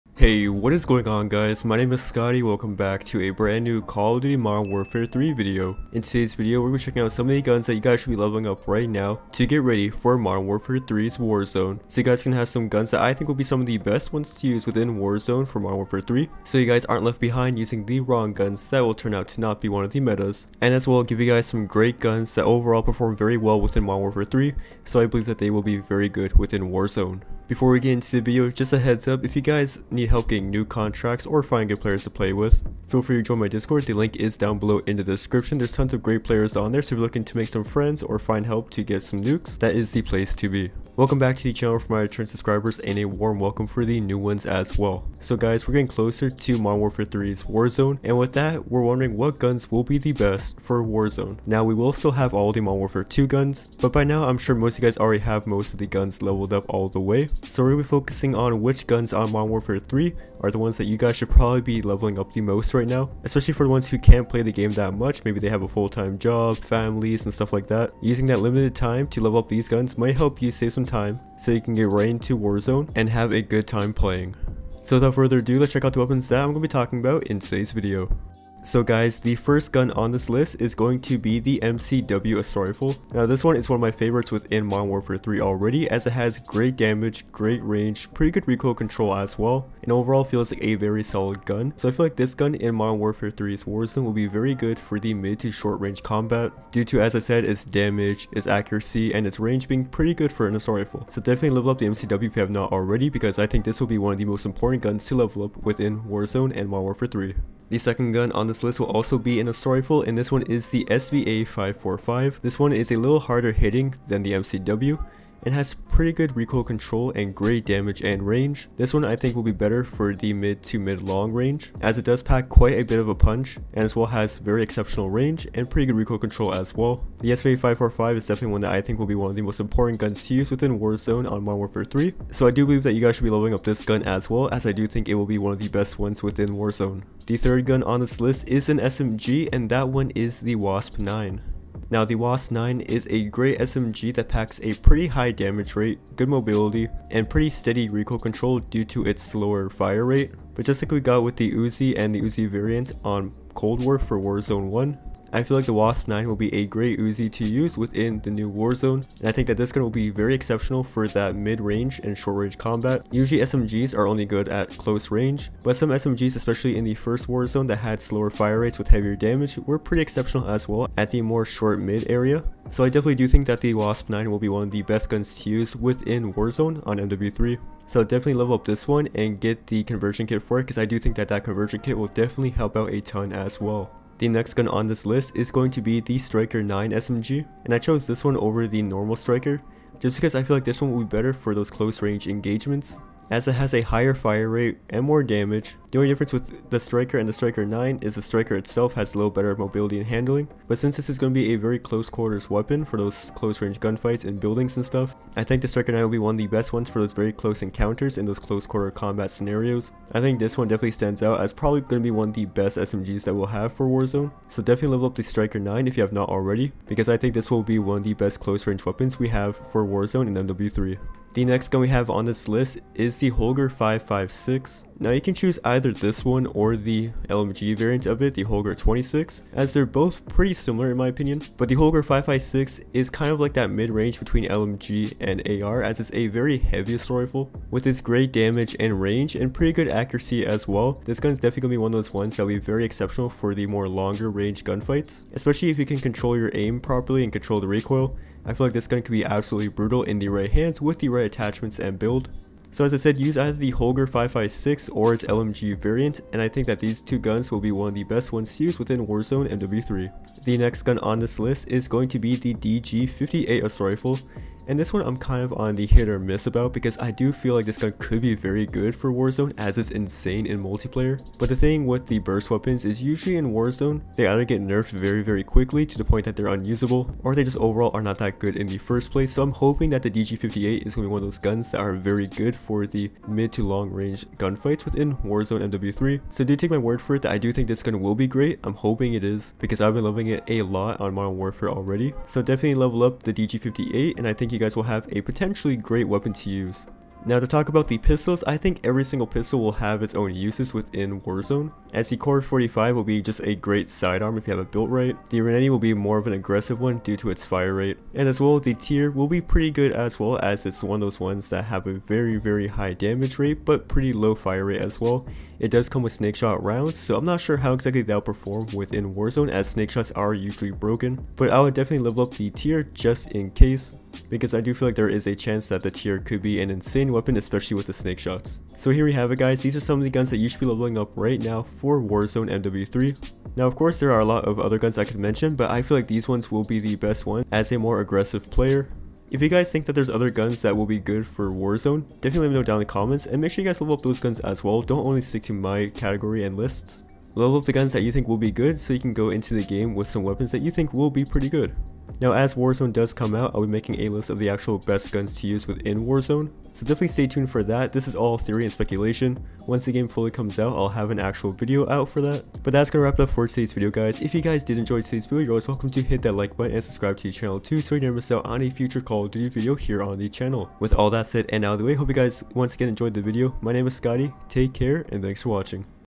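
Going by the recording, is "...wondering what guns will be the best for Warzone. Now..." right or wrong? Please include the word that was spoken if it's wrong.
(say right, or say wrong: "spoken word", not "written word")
right.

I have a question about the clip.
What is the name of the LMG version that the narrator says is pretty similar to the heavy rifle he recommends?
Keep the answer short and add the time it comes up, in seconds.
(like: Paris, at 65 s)
Holger 26, at 228 s.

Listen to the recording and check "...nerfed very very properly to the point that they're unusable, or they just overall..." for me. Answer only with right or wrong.
wrong.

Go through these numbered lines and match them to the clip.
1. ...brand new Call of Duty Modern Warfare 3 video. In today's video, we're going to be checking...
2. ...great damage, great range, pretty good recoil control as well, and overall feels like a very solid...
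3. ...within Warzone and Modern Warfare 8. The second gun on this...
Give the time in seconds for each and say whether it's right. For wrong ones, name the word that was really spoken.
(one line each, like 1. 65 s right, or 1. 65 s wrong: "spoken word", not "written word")
1. 3 s right
2. 86 s right
3. 105 s wrong: "3", not "8".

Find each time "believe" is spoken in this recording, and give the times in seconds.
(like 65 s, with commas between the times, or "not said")
25 s, 132 s.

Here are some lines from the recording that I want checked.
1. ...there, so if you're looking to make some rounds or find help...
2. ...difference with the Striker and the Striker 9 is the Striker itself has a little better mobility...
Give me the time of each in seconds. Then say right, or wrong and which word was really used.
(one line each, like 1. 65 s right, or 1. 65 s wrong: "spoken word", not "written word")
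1. 36 s wrong: "friends", not "rounds"
2. 196 s right.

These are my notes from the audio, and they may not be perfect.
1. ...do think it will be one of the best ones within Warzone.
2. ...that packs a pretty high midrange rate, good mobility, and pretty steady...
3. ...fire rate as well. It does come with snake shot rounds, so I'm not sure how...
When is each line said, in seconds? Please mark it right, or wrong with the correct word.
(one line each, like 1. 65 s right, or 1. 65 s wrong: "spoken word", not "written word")
1. 134 s right
2. 144 s wrong: "damage", not "midrange"
3. 314 s right.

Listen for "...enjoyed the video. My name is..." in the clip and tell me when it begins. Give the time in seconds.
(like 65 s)
372 s.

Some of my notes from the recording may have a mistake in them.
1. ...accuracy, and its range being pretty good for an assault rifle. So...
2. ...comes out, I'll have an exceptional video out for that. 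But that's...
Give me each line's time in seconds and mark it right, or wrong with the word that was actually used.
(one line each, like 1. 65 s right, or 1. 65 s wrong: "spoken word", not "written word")
1. 98 s right
2. 360 s wrong: "actual", not "exceptional".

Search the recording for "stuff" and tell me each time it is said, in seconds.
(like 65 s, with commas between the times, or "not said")
67 s, 204 s.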